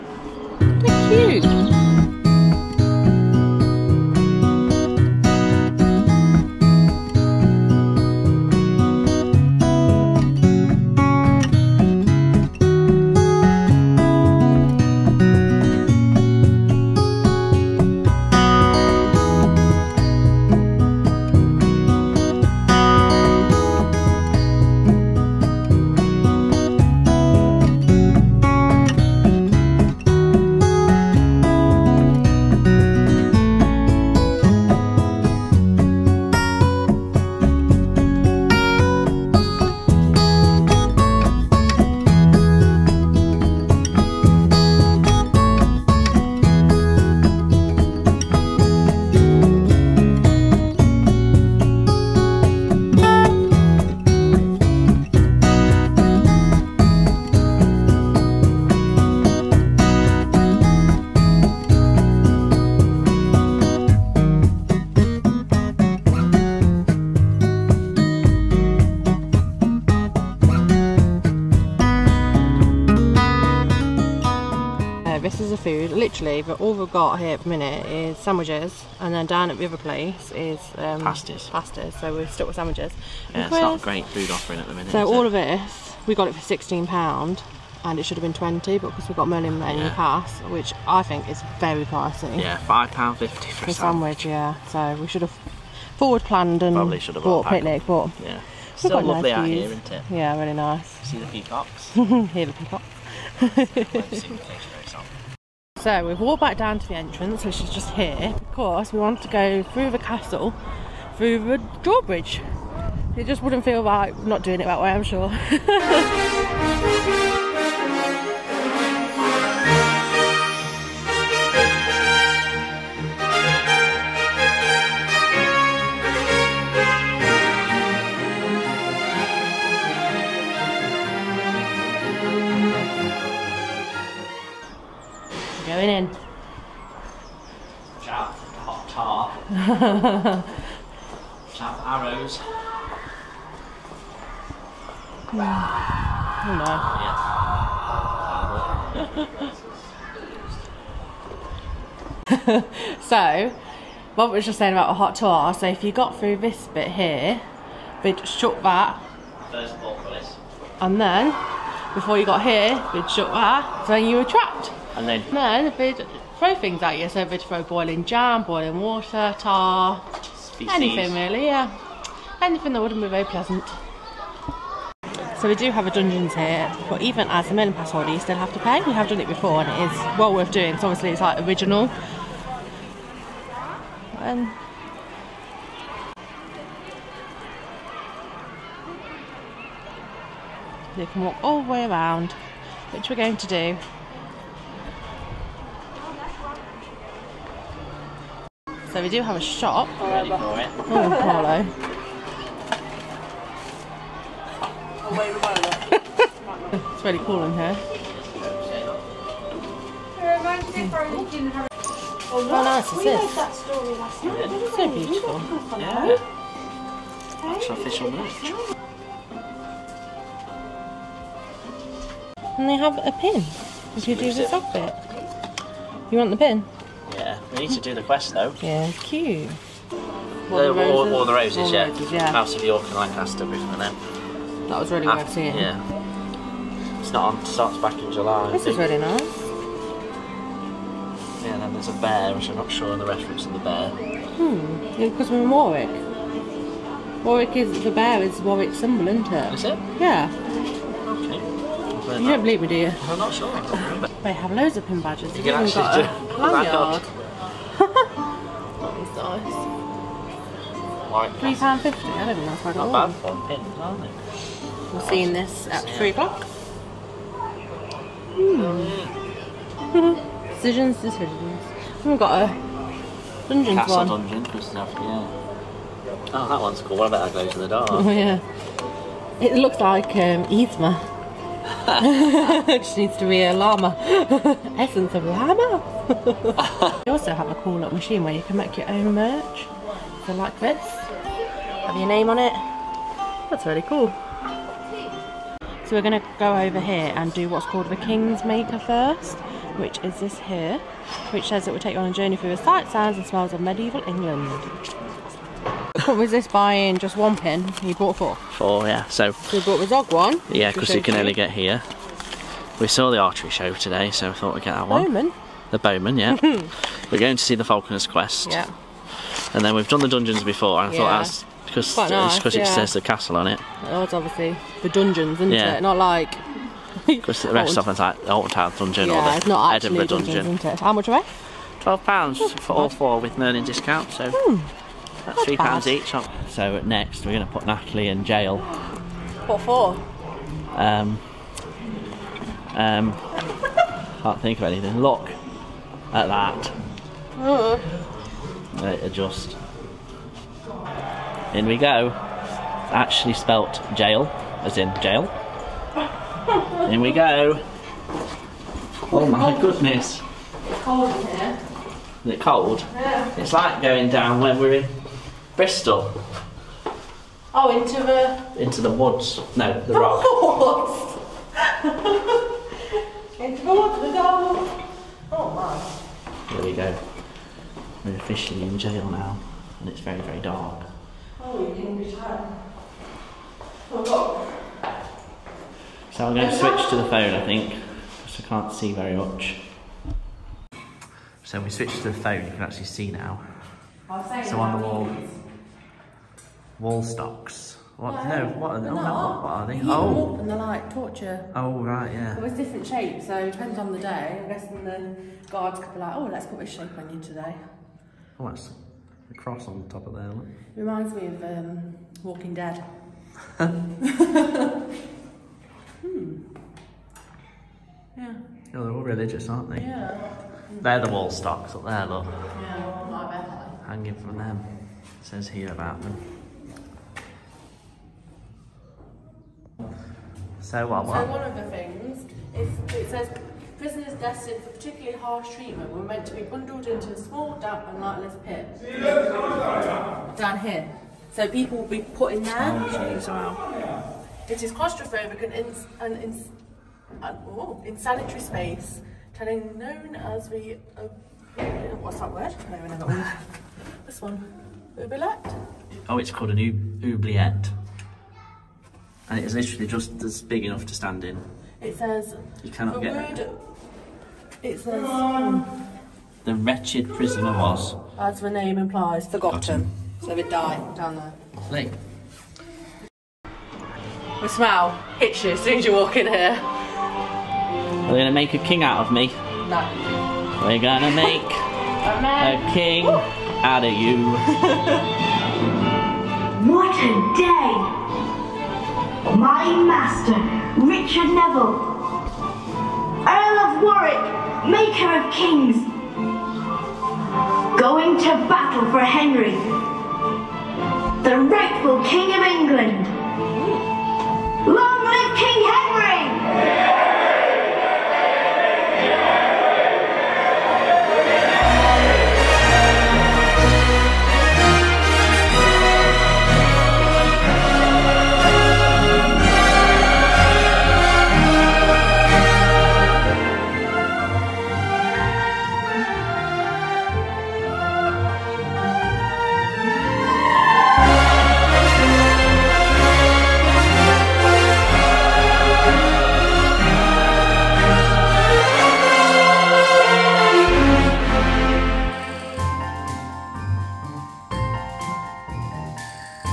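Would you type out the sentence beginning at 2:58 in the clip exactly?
We have done it before, and it is well worth doing.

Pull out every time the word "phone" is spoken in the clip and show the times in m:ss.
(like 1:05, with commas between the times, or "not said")
6:27, 6:32.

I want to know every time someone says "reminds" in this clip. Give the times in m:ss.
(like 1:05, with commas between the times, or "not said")
6:50.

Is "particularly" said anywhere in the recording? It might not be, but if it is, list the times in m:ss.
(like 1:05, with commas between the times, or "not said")
7:14.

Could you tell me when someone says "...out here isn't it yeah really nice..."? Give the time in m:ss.
1:39.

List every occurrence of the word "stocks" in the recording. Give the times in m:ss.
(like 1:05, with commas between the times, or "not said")
6:37, 7:01.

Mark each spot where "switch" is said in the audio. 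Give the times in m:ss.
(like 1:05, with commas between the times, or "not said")
6:26, 6:31.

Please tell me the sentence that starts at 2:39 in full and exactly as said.
There's And then, before you got here, we'd shut that, so you were trapped.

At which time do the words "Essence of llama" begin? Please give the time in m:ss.
4:44.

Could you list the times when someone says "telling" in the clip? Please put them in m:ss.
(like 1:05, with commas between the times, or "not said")
7:29.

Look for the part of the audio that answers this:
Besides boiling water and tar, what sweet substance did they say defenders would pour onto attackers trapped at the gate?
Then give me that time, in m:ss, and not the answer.
2:47.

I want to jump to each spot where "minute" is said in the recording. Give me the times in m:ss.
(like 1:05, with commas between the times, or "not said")
1:17, 1:24.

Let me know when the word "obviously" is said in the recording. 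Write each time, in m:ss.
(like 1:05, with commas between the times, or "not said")
3:00, 5:24.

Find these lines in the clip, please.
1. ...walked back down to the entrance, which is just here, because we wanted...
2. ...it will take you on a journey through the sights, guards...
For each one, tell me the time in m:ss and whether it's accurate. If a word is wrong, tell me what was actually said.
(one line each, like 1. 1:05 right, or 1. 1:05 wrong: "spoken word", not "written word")
1. 1:46 right
2. 5:01 wrong: "sounds", not "guards".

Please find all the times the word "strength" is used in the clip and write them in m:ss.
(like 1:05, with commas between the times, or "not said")
not said.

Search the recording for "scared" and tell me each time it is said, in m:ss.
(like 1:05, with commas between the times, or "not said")
not said.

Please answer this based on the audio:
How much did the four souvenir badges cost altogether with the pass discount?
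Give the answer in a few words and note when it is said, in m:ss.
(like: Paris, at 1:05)
£12, at 5:31.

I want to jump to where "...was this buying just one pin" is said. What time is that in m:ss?
5:06.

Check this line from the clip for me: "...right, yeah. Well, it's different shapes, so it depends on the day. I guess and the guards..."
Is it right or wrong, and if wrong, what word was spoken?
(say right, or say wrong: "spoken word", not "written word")
right.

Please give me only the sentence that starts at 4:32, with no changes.
We've got a dungeon Castle dungeon yeah.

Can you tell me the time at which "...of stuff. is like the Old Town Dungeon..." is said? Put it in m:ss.
5:27.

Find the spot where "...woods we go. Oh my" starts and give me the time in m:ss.
6:13.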